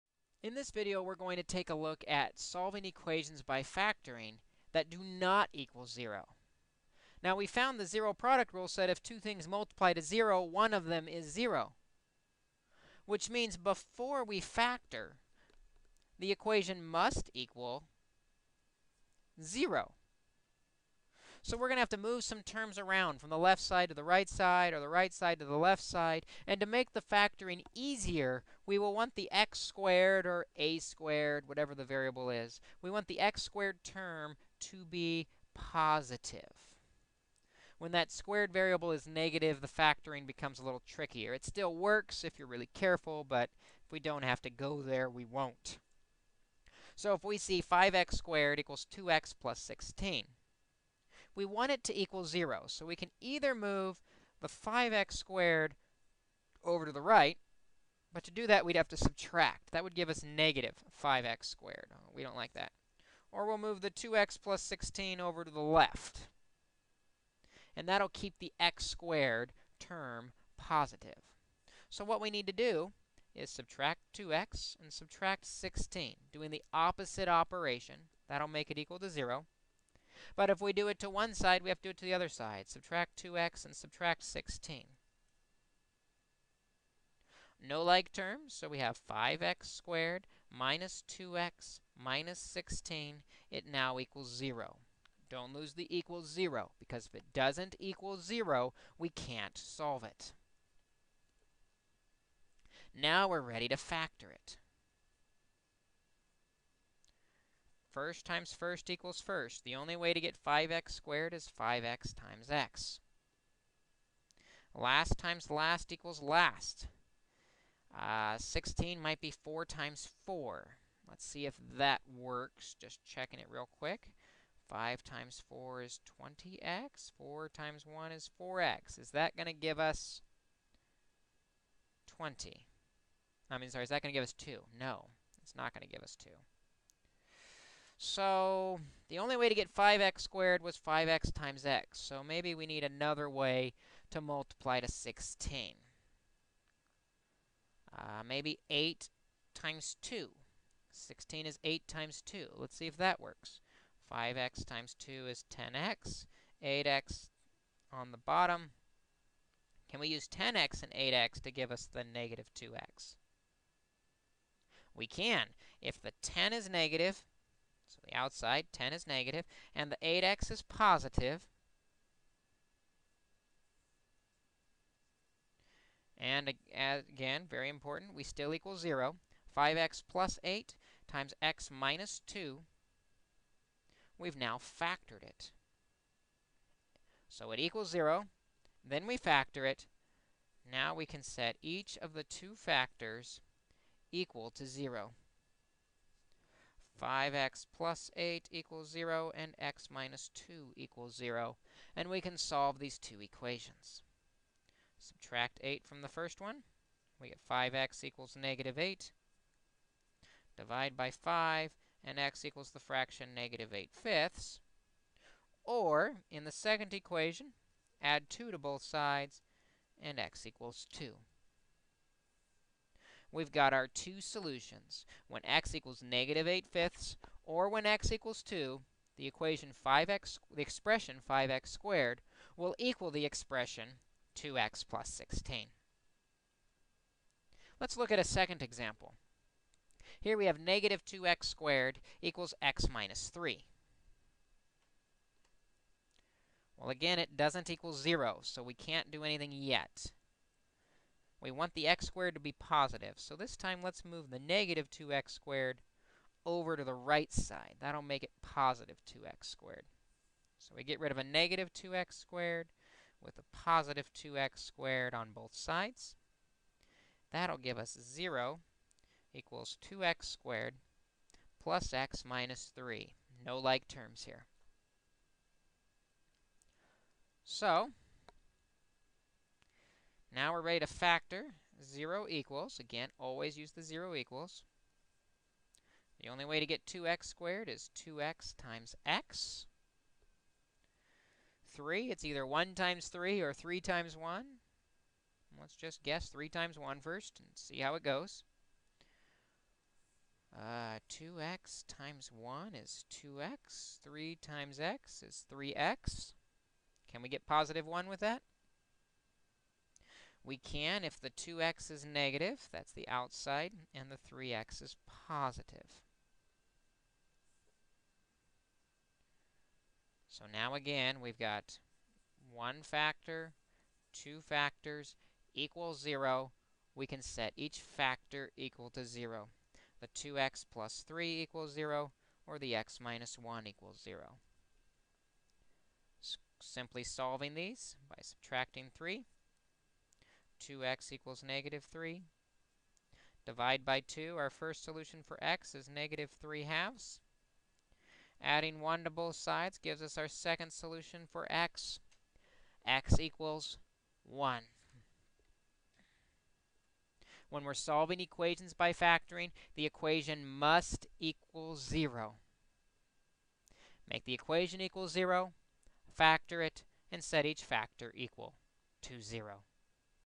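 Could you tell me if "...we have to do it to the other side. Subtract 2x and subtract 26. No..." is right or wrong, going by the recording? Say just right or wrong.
wrong.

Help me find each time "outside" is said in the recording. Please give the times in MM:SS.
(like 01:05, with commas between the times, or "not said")
02:48, 05:13.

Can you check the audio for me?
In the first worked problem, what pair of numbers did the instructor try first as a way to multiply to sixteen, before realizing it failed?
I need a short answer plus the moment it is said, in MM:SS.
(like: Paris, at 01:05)
4 times 4, at 01:59.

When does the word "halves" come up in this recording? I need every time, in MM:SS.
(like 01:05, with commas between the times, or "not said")
05:46.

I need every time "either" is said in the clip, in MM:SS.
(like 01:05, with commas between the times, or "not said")
00:53, 04:52.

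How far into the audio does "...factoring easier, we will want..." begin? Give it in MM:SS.
00:27.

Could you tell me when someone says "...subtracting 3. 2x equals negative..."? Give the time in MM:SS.
05:38.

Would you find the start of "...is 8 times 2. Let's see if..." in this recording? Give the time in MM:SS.
02:31.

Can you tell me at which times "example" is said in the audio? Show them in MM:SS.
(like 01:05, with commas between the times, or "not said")
03:58.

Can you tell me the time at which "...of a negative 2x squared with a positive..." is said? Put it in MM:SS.
04:21.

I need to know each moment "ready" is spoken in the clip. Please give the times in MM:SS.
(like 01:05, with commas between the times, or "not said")
01:43, 04:40.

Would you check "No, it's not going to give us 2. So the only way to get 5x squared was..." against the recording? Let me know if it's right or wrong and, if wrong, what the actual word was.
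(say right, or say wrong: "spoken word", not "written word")
right.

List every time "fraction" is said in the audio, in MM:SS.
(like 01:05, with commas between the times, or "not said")
03:32.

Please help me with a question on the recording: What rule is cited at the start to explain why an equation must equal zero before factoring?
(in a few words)
zero product rule.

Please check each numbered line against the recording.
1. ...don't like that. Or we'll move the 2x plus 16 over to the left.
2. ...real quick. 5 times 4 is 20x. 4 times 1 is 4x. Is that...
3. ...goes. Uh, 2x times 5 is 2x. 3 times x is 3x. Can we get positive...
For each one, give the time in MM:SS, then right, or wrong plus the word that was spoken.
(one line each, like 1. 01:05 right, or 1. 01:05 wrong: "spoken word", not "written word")
1. 01:02 right
2. 02:03 right
3. 04:58 wrong: "1", not "5".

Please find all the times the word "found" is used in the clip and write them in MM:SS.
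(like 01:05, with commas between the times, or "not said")
00:07.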